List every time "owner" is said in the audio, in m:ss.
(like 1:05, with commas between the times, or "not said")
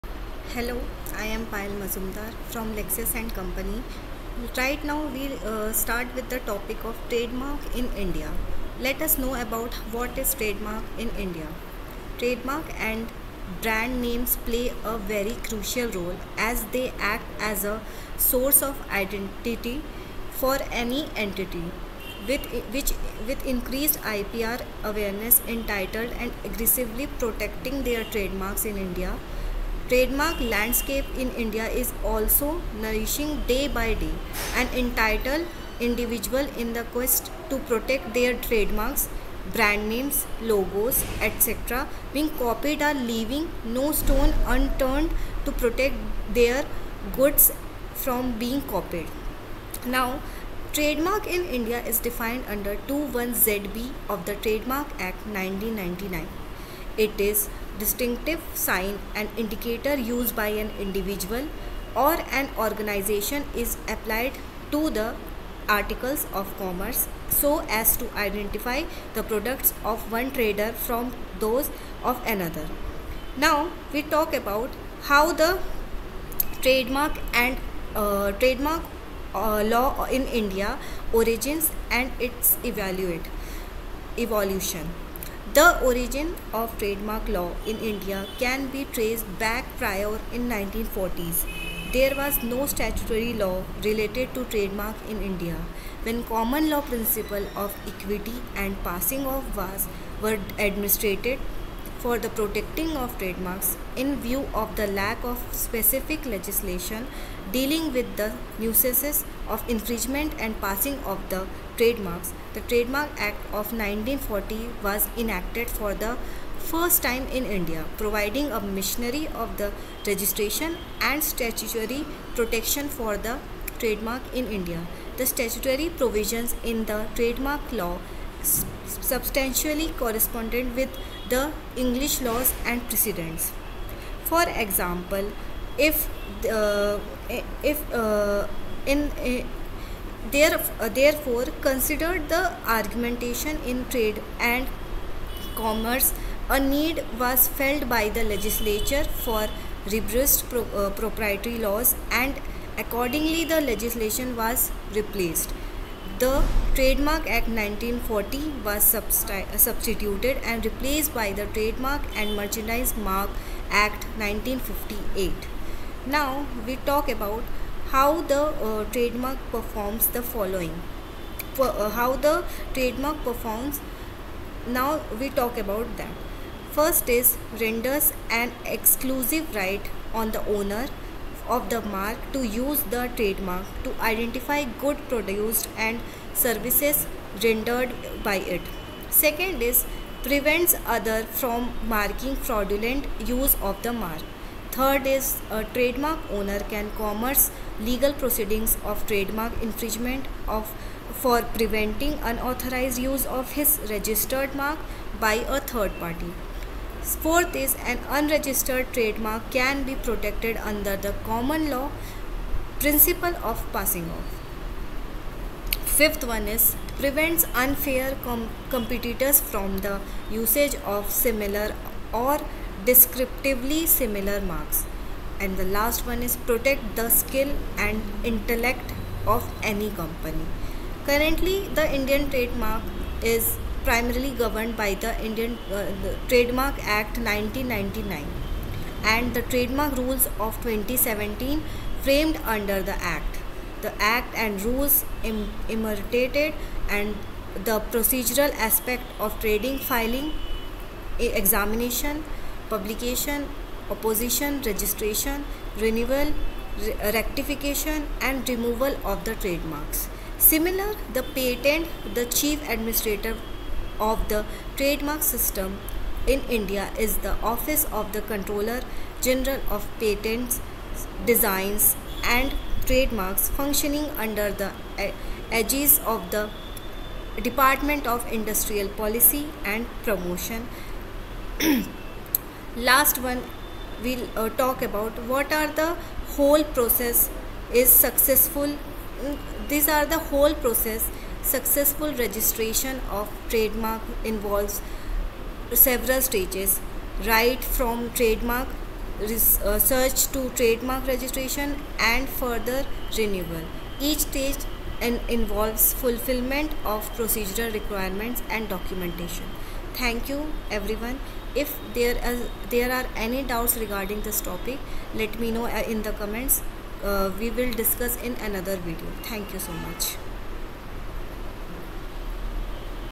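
3:00, 3:16.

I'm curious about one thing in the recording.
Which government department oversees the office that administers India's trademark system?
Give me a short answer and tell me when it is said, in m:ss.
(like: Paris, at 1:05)
Department of Industrial Policy and Promotion, at 4:37.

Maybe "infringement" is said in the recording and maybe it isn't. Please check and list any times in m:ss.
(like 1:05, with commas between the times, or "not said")
1:49, 3:19.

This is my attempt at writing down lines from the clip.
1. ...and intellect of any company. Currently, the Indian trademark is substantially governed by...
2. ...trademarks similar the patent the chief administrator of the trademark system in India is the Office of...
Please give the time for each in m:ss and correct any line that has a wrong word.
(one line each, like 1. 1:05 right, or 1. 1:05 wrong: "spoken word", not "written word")
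1. 3:47 wrong: "primarily", not "substantially"
2. 4:19 right.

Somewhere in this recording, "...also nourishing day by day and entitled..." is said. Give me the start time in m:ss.
0:32.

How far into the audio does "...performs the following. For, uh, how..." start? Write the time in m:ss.
2:49.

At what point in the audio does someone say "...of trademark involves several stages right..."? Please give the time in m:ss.
4:53.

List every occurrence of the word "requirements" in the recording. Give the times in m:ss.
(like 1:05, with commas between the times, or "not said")
5:07.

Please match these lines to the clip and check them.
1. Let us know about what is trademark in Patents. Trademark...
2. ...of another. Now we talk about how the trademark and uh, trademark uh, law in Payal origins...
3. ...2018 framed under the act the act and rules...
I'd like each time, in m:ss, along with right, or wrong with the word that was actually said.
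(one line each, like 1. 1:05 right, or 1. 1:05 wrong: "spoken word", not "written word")
1. 0:08 wrong: "India", not "Patents"
2. 1:12 wrong: "India", not "Payal"
3. 4:00 wrong: "2017", not "2018".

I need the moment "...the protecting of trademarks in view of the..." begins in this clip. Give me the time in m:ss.
1:42.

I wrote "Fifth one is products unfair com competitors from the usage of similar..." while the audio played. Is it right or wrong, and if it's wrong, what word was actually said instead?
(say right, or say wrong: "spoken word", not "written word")
wrong: "prevents", not "products".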